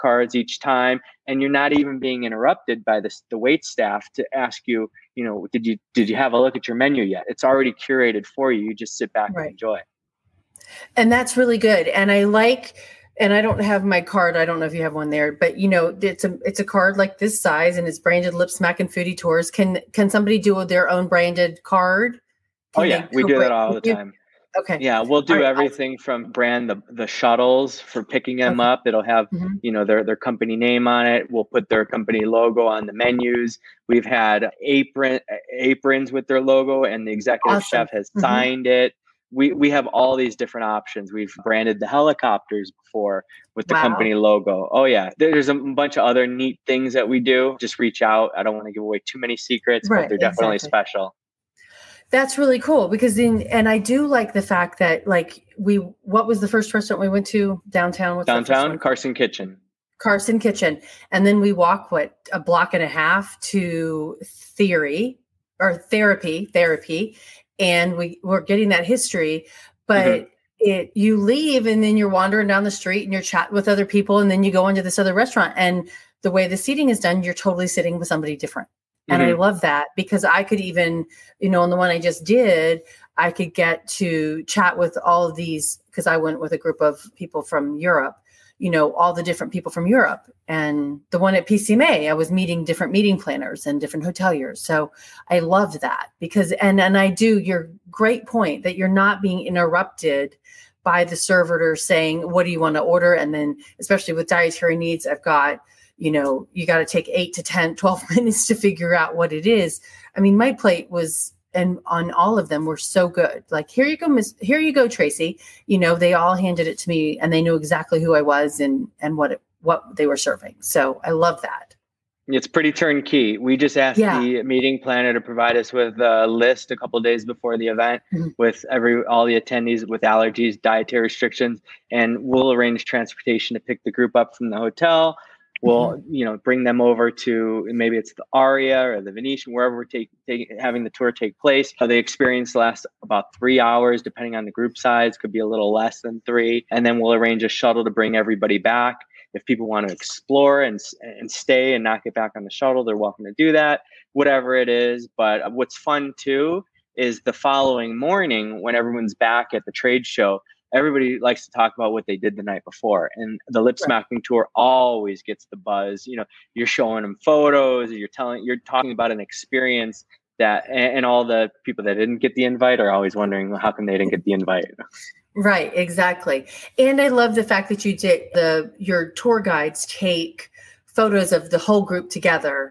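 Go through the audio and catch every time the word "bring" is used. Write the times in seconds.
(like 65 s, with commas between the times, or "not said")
136 s, 147 s.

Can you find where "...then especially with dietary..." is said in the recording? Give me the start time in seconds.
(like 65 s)
103 s.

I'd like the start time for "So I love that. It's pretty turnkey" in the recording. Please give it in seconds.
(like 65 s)
120 s.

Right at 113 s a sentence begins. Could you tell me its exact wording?
Like, here you go, Miss, here you go, Tracy.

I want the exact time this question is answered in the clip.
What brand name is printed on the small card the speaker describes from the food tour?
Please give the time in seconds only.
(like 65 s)
18 s.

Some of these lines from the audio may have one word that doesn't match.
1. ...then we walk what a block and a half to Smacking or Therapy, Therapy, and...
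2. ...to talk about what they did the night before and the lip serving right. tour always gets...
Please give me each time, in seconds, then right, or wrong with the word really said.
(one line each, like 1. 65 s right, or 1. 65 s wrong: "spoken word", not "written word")
1. 61 s wrong: "Theory", not "Smacking"
2. 161 s wrong: "smacking", not "serving".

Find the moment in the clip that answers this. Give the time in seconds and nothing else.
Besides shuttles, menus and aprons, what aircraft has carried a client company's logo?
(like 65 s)
41 s.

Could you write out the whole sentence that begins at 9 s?
and enjoy it and that's really good.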